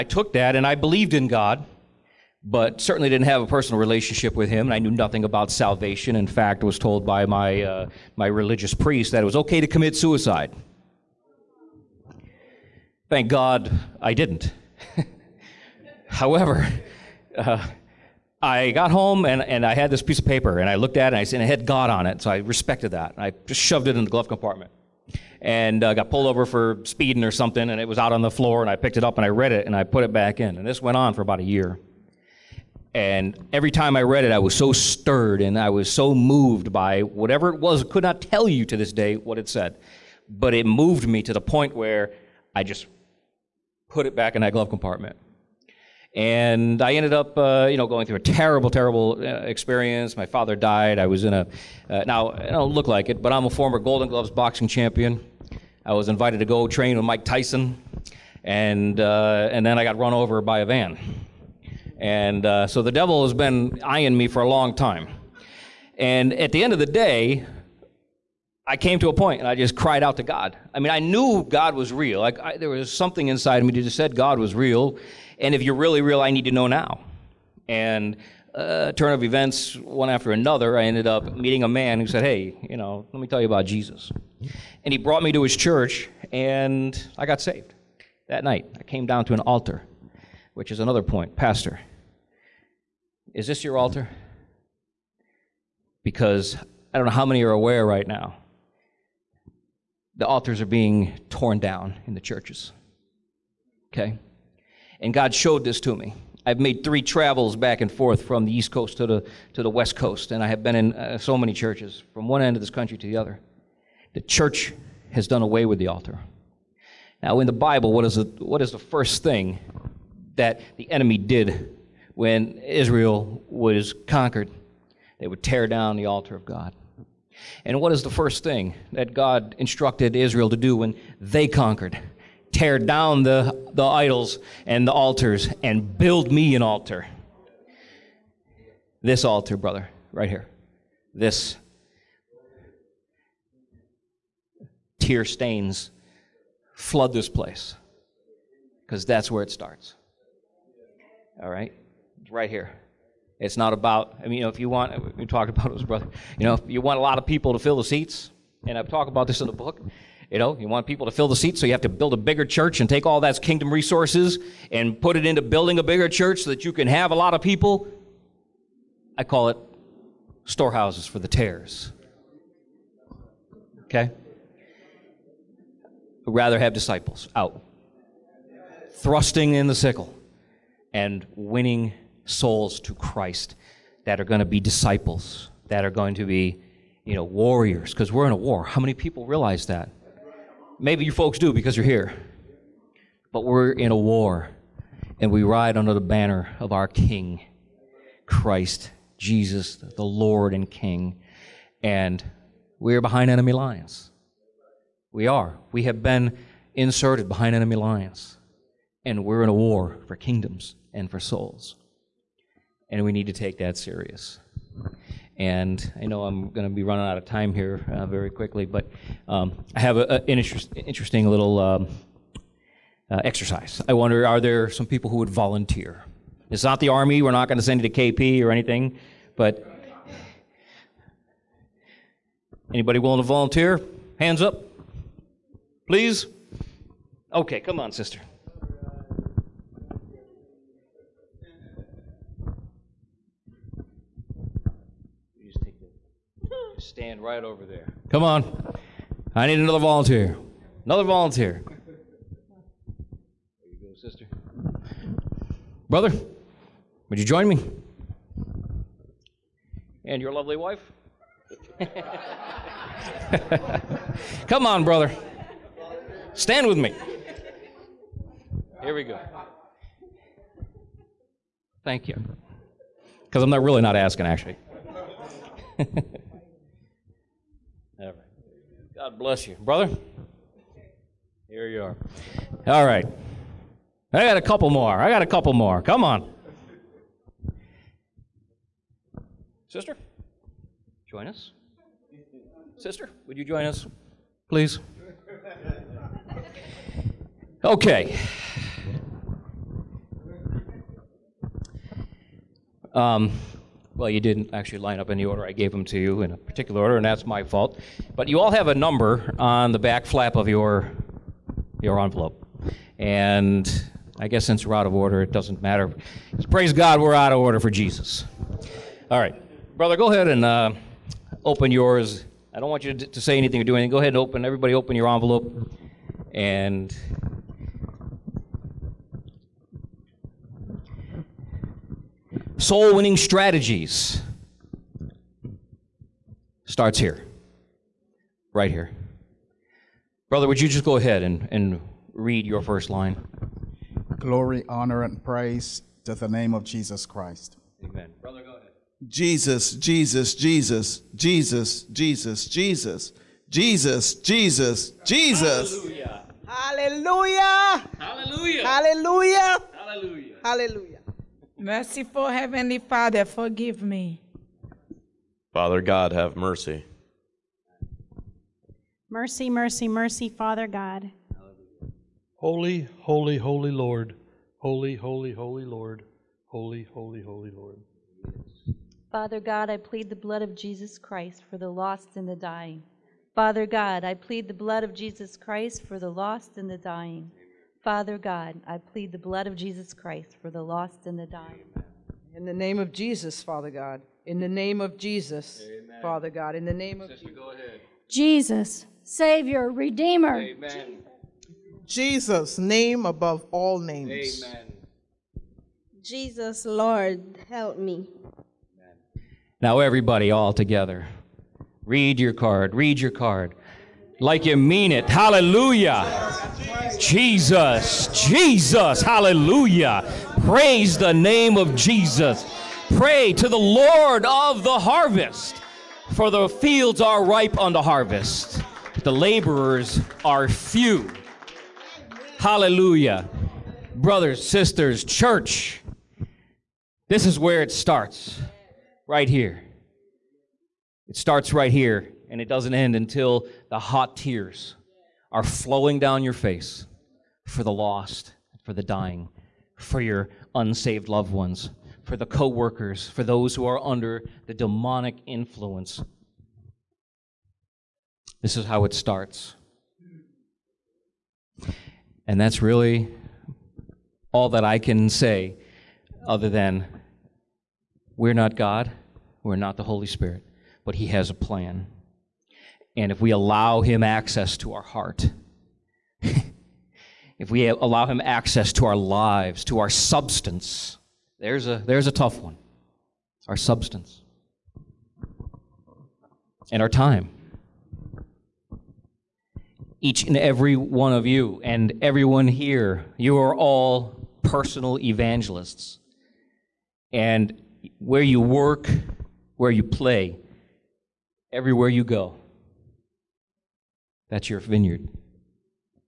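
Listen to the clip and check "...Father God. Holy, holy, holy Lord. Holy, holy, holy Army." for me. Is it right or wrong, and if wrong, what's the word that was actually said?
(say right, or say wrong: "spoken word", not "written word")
wrong: "Lord", not "Army".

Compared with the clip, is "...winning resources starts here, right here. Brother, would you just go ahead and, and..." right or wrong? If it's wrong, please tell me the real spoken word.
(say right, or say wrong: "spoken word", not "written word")
wrong: "strategies", not "resources".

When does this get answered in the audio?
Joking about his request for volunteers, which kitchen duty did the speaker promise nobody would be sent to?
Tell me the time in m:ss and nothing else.
3:48.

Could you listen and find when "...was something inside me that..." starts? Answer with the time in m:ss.
1:12.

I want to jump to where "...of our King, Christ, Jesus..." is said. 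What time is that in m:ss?
3:16.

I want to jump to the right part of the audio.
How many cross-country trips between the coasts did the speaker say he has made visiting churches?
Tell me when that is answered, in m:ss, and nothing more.
1:46.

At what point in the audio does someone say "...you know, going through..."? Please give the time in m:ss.
0:47.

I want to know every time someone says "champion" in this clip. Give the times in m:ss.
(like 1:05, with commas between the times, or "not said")
0:54.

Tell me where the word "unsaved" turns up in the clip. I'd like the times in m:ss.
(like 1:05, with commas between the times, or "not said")
7:30.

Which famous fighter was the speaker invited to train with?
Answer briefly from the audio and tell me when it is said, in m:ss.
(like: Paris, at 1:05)
Mike Tyson, at 0:57.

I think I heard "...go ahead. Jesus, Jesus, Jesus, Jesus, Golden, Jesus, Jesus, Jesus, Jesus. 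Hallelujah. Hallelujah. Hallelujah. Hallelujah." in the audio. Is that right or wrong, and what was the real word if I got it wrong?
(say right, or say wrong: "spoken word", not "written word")
wrong: "Jesus", not "Golden".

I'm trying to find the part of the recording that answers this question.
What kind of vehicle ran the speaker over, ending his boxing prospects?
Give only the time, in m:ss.
1:00.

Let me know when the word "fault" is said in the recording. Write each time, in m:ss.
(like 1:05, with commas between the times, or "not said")
5:07.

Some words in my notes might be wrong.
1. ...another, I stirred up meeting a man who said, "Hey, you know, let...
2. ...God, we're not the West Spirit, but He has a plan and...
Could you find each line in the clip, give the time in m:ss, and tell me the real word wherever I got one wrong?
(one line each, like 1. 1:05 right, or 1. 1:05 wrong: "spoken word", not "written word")
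1. 1:20 wrong: "ended", not "stirred"
2. 7:48 wrong: "Holy", not "West".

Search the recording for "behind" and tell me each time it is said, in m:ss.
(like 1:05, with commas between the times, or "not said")
3:23, 3:27.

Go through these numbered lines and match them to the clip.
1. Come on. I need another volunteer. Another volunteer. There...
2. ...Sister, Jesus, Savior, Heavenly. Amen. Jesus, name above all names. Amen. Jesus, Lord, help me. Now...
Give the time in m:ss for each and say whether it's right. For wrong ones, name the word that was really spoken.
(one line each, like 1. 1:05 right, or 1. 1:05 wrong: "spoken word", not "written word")
1. 4:08 right
2. 6:37 wrong: "Redeemer", not "Heavenly".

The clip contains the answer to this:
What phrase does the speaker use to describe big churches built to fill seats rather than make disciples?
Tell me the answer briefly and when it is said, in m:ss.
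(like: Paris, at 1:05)
Storehouses for the tares, at 2:50.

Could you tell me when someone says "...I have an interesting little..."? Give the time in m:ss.
3:39.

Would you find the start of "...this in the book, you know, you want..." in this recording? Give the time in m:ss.
2:39.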